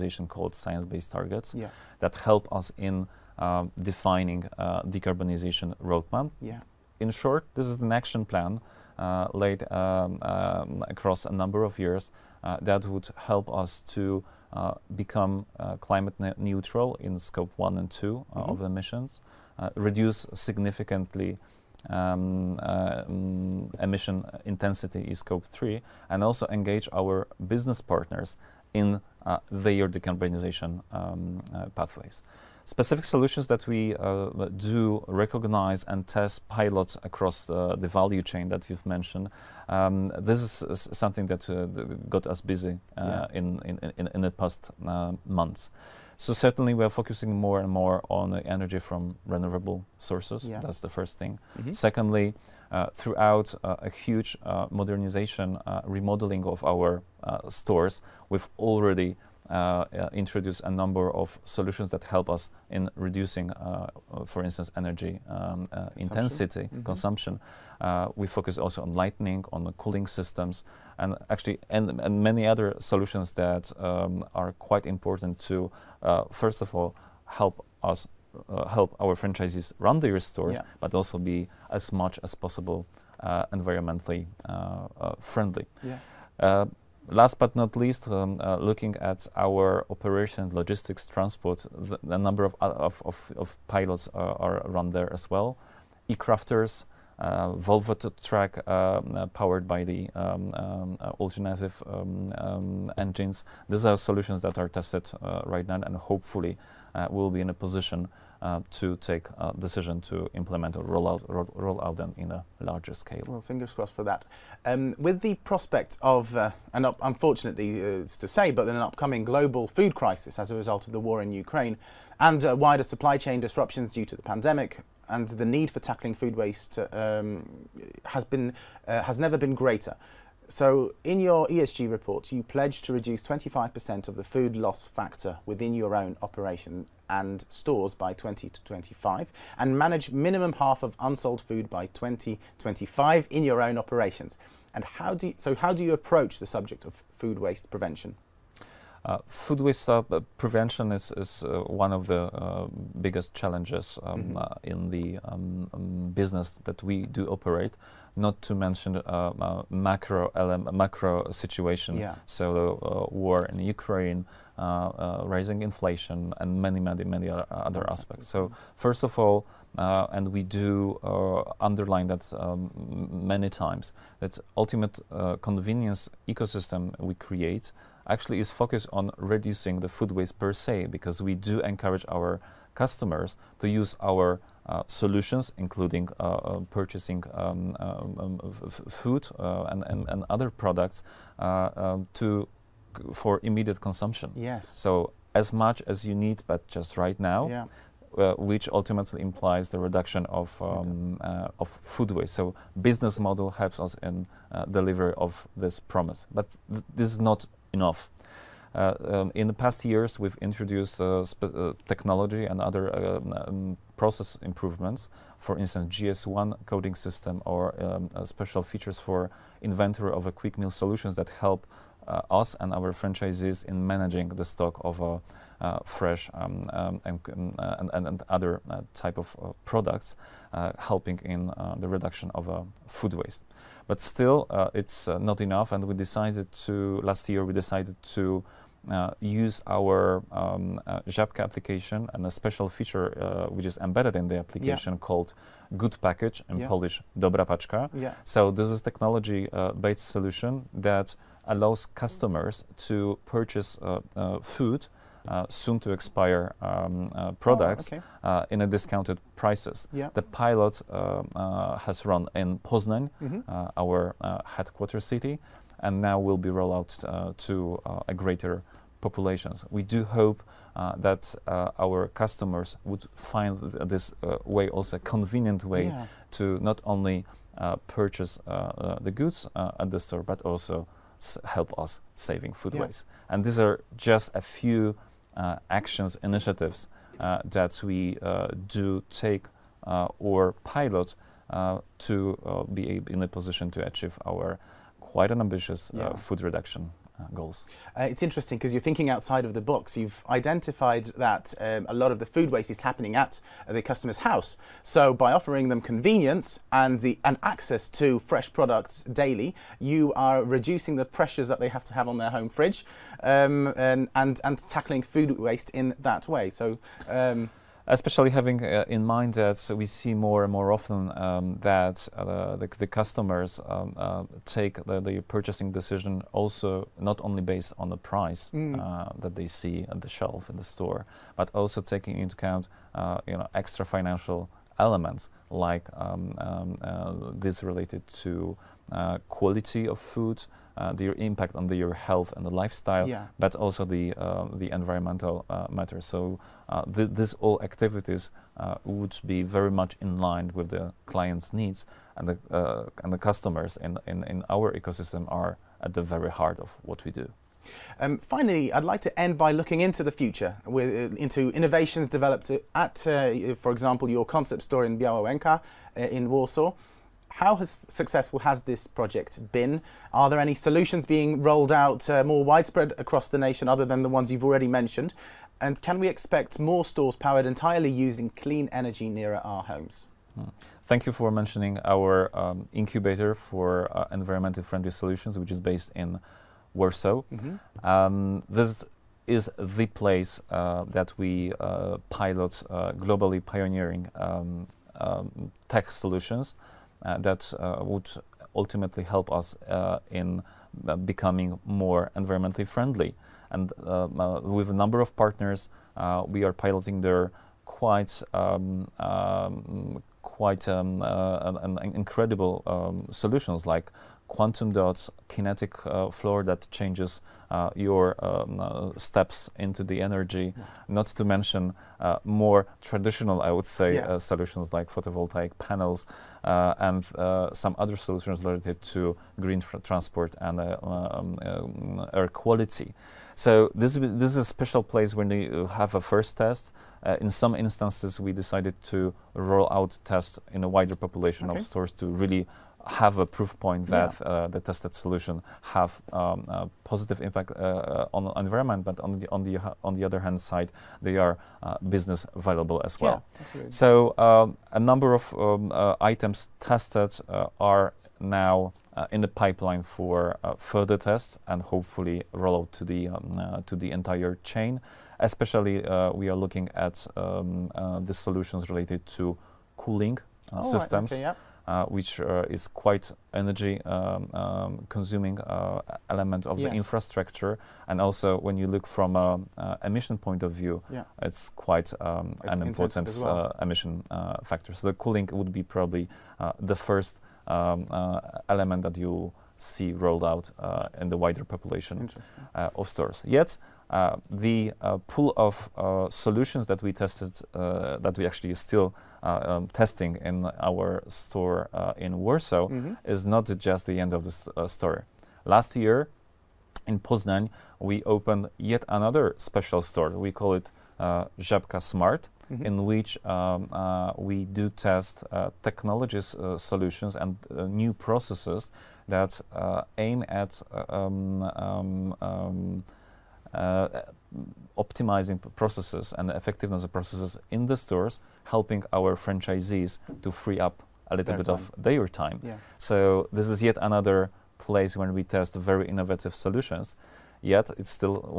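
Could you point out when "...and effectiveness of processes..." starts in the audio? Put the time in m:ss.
8:46.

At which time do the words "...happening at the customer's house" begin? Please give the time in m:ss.
5:02.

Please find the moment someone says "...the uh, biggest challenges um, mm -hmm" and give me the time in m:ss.
2:32.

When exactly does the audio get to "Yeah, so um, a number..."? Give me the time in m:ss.
7:33.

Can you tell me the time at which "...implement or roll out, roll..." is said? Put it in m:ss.
1:50.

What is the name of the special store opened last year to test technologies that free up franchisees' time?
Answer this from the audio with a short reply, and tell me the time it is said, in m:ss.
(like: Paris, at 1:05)
Żabka Smart, at 8:31.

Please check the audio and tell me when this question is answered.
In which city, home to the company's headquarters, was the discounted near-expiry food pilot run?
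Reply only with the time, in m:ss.
4:22.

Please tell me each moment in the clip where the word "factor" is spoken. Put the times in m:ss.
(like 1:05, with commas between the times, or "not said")
2:14, 8:04.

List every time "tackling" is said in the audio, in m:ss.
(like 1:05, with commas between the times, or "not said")
2:05, 5:14.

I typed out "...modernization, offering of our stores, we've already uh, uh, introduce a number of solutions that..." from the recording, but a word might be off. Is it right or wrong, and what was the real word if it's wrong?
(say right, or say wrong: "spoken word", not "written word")
wrong: "remodeling", not "offering".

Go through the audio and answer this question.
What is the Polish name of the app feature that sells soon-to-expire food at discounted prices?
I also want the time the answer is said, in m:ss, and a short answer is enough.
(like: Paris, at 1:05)
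Dobra Paczka, at 4:07.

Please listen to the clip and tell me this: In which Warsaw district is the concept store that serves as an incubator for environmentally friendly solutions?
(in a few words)
Białołęka.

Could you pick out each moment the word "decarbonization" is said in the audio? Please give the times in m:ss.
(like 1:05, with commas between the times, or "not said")
0:04, 0:29.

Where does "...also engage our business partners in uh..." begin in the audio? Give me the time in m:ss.
0:26.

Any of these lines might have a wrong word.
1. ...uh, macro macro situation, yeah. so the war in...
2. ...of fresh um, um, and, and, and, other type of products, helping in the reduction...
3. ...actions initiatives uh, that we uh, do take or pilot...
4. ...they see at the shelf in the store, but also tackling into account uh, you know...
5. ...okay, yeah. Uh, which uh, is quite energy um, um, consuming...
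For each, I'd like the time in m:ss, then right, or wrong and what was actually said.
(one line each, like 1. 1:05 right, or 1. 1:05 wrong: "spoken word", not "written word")
1. 2:38 right
2. 3:44 right
3. 4:45 right
4. 5:29 wrong: "taking", not "tackling"
5. 7:51 right.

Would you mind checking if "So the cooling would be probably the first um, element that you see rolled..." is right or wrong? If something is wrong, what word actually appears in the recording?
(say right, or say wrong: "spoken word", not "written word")
right.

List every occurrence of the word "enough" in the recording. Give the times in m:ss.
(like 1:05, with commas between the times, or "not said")
3:27, 3:55.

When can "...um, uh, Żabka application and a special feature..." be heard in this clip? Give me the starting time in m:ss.
4:00.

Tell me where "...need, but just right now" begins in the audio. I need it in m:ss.
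3:16.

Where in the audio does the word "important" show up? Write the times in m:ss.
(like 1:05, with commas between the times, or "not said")
1:14, 8:02.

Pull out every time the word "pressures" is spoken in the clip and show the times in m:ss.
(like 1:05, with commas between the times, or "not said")
5:11.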